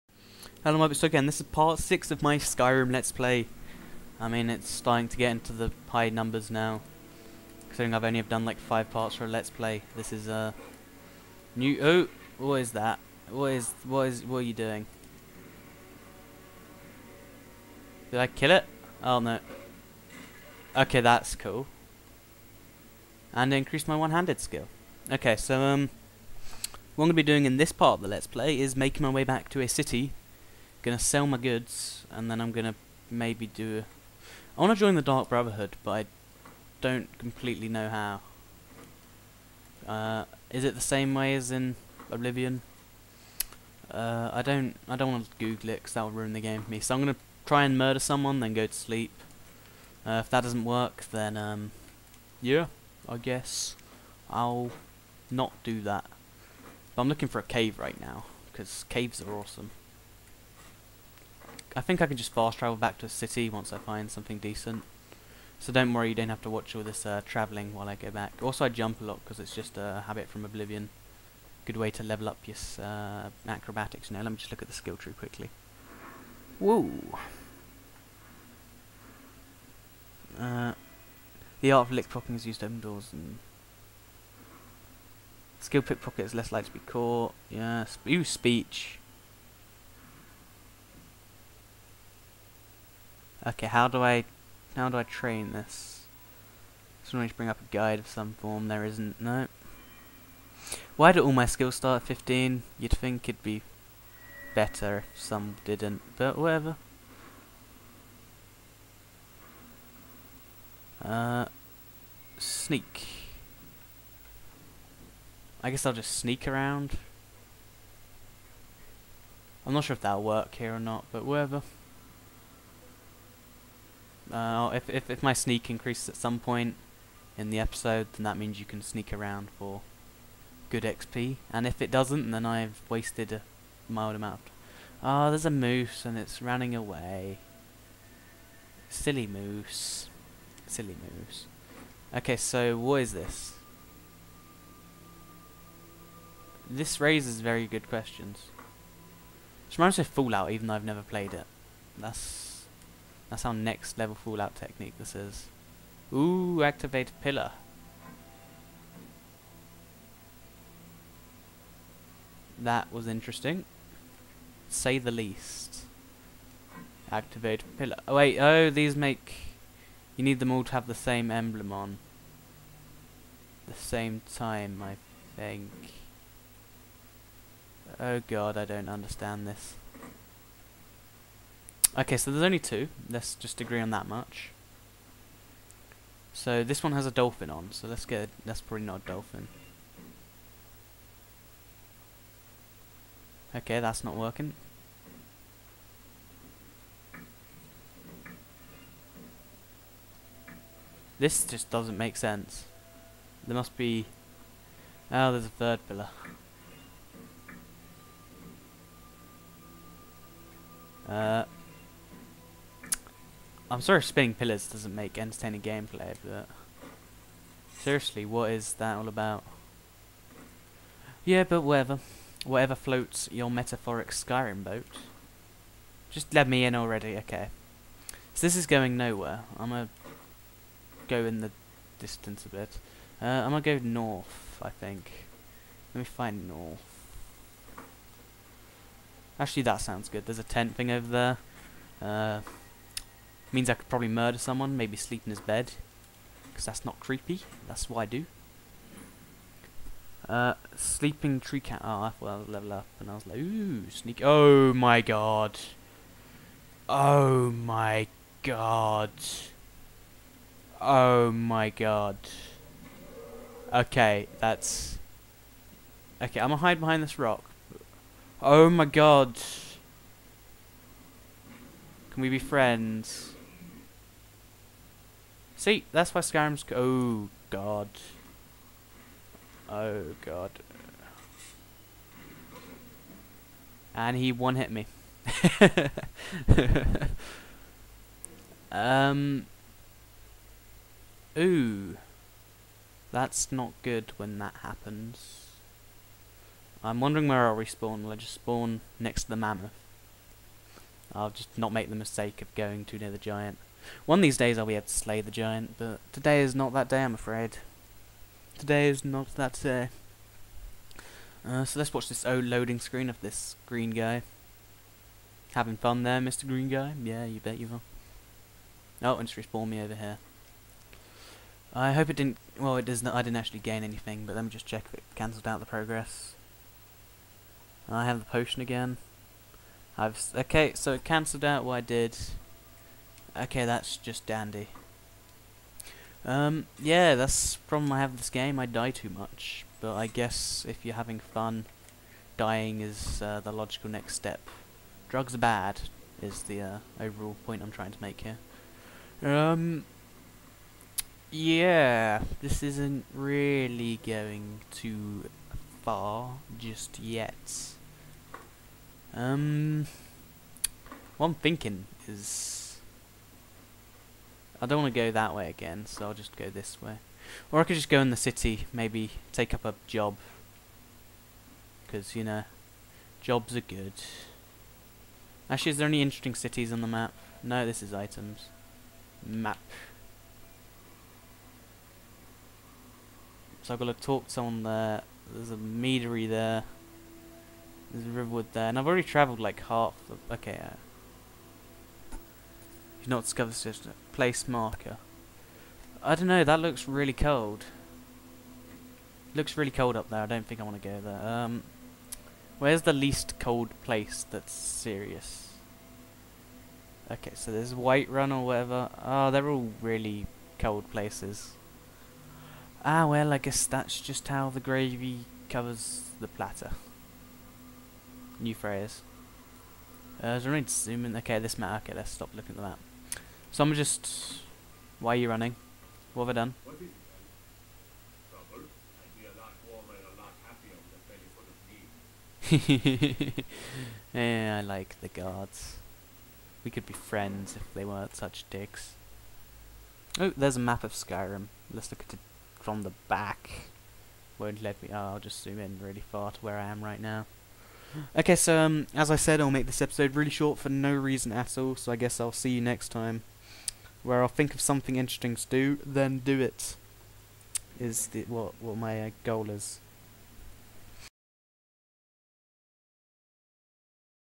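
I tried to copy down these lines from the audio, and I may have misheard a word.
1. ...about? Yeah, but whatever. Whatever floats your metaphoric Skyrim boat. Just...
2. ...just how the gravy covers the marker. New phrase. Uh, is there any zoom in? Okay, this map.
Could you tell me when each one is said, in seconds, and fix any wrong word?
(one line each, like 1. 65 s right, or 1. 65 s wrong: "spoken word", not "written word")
1. 219 s right
2. 413 s wrong: "platter", not "marker".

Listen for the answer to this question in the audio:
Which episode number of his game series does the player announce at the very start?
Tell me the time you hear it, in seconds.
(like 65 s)
1 s.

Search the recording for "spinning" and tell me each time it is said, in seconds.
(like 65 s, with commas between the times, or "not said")
214 s.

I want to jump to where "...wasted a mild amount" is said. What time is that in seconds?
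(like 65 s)
132 s.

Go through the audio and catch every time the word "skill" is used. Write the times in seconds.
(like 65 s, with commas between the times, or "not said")
24 s, 74 s, 85 s, 101 s.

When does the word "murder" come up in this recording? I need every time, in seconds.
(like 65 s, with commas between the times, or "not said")
47 s, 244 s.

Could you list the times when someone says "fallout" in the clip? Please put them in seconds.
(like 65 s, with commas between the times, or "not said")
150 s, 154 s.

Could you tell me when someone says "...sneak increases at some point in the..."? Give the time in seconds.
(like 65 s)
125 s.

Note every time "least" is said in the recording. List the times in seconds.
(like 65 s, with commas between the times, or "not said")
165 s, 402 s.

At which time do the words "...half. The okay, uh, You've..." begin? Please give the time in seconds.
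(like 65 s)
389 s.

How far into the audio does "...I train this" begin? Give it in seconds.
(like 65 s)
94 s.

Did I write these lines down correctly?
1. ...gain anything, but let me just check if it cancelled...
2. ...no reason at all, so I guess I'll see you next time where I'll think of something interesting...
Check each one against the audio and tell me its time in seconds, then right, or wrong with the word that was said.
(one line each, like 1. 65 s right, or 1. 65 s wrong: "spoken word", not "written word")
1. 323 s right
2. 450 s right.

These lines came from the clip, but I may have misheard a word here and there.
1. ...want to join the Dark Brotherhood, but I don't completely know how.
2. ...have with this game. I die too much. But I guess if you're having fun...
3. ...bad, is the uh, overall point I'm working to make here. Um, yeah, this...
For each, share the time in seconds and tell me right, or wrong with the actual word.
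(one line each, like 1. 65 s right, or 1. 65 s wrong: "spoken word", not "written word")
1. 34 s right
2. 337 s right
3. 345 s wrong: "trying", not "working".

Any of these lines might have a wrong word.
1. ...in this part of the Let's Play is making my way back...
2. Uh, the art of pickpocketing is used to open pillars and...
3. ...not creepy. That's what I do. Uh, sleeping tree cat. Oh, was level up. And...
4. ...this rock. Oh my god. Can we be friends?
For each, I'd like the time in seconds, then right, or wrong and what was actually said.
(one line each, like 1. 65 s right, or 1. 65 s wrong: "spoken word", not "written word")
1. 27 s right
2. 80 s wrong: "doors", not "pillars"
3. 246 s right
4. 267 s right.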